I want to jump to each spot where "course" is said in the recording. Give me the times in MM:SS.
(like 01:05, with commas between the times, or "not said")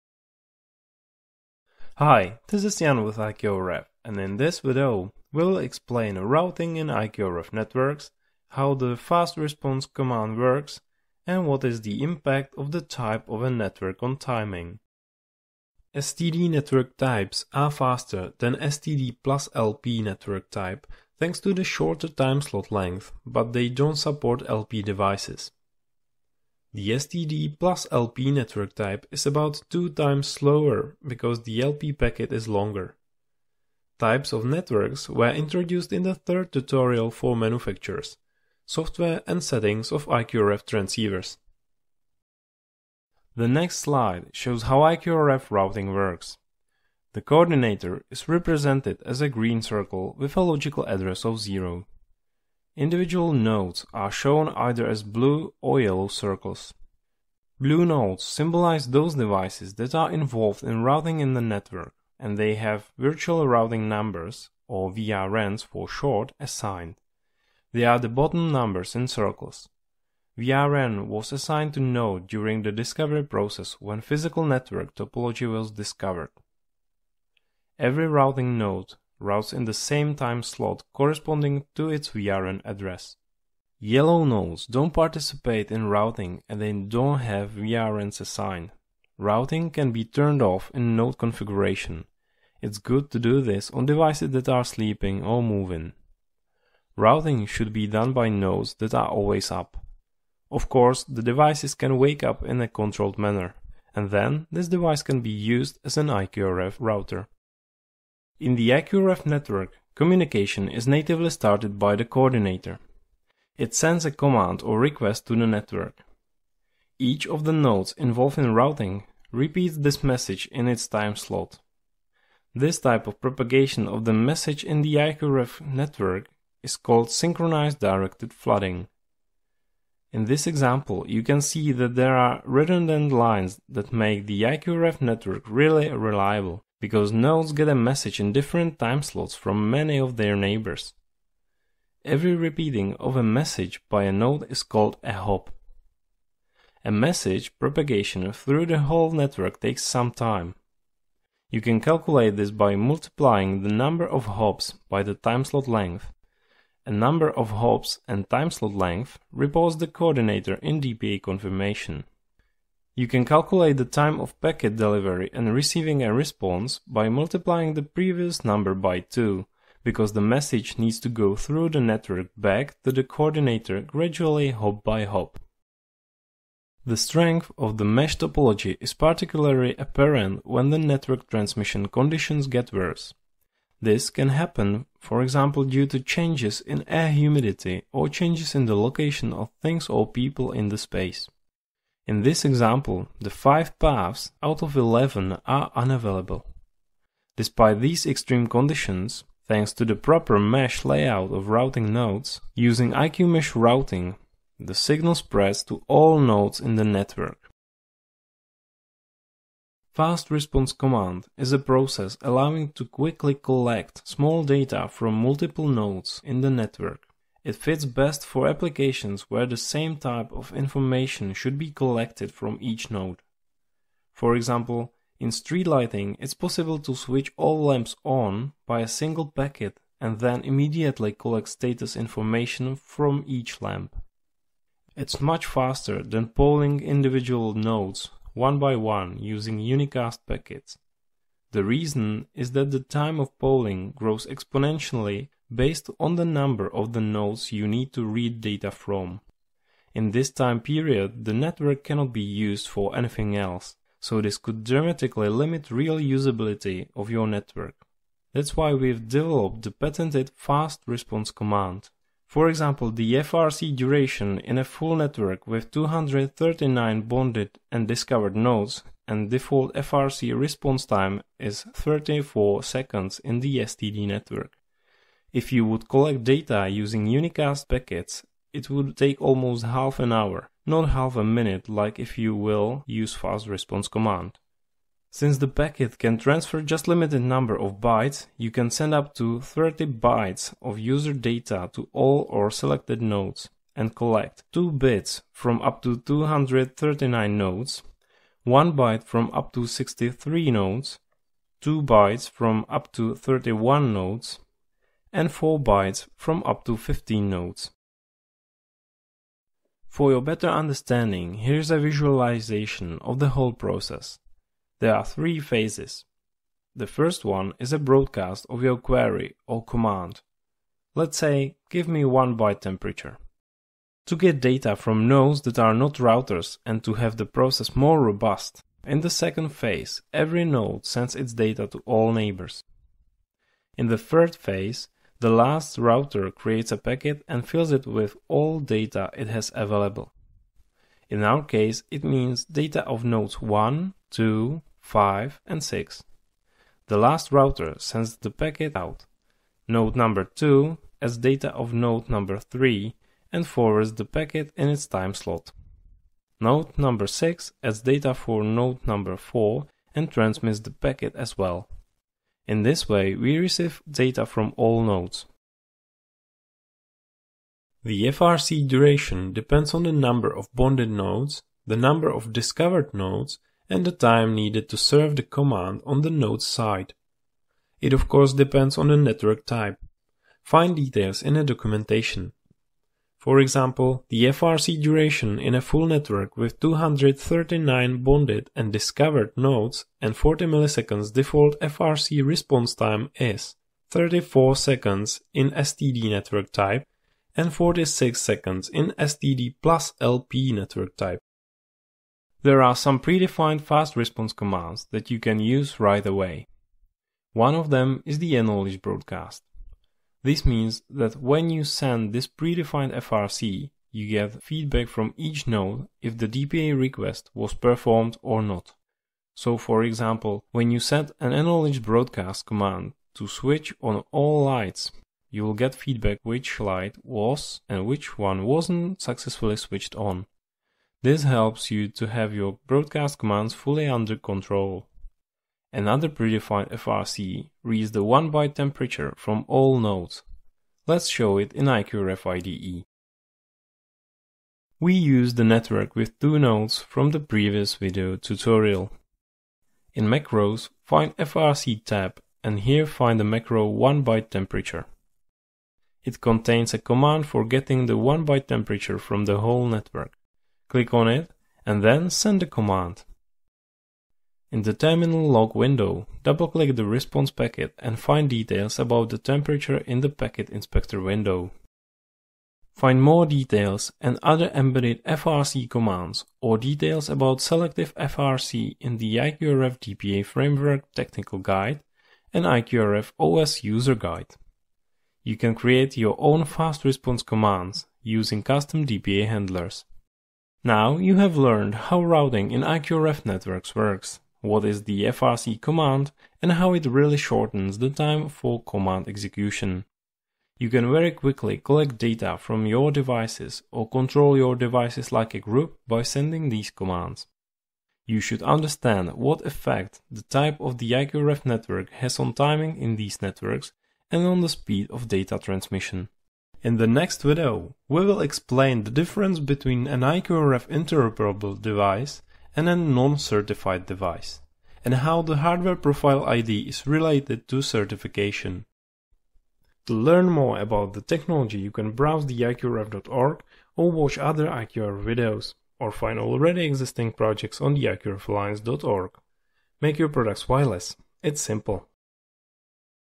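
01:40, 06:18.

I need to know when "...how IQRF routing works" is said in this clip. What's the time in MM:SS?
00:44.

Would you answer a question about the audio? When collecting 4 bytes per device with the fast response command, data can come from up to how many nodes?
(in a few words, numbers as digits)
15.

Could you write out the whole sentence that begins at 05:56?
Node number 6 adds data for node number 4 and transmits the packet as well.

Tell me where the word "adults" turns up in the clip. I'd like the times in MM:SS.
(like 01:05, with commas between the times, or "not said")
not said.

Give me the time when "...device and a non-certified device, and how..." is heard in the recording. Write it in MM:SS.
08:41.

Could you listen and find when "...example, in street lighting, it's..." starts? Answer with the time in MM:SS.
03:44.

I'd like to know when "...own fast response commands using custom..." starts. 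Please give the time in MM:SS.
08:06.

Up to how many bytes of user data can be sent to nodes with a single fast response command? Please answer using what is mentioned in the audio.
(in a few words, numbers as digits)
30 bytes.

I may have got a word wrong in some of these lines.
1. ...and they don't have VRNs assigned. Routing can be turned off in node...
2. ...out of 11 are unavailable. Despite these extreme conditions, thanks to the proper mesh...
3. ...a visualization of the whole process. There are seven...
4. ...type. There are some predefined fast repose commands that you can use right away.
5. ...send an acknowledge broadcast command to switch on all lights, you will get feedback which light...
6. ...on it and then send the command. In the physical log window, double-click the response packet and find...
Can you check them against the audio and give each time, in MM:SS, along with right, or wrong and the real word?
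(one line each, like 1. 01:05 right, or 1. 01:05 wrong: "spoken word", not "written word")
1. 01:26 right
2. 03:14 right
3. 05:11 wrong: "three", not "seven"
4. 06:40 wrong: "response", not "repose"
5. 07:00 right
6. 07:40 wrong: "terminal", not "physical".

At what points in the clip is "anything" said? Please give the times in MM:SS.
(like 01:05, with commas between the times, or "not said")
04:12.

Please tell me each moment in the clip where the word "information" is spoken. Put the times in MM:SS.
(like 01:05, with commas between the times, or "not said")
03:40, 03:51.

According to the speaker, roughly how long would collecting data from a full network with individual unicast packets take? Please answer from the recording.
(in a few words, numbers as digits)
almost half an hour.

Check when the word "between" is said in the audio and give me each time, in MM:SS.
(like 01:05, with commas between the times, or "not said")
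08:39.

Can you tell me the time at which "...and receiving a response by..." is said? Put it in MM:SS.
02:45.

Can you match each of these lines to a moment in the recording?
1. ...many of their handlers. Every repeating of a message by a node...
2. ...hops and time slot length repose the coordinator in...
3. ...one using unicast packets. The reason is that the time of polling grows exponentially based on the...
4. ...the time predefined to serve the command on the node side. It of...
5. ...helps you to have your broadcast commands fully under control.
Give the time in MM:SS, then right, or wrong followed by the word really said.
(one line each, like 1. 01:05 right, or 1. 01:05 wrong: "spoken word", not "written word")
1. 02:19 wrong: "neighbors", not "handlers"
2. 02:37 right
3. 03:58 right
4. 06:13 wrong: "needed", not "predefined"
5. 07:11 right.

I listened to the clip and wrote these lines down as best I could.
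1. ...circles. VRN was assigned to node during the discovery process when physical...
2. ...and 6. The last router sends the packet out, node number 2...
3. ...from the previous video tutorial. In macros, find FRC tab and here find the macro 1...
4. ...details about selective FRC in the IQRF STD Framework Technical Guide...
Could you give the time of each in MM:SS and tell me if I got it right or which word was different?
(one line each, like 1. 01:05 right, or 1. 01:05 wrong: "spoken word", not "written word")
1. 01:09 right
2. 05:45 right
3. 07:26 right
4. 07:56 wrong: "DPA", not "STD".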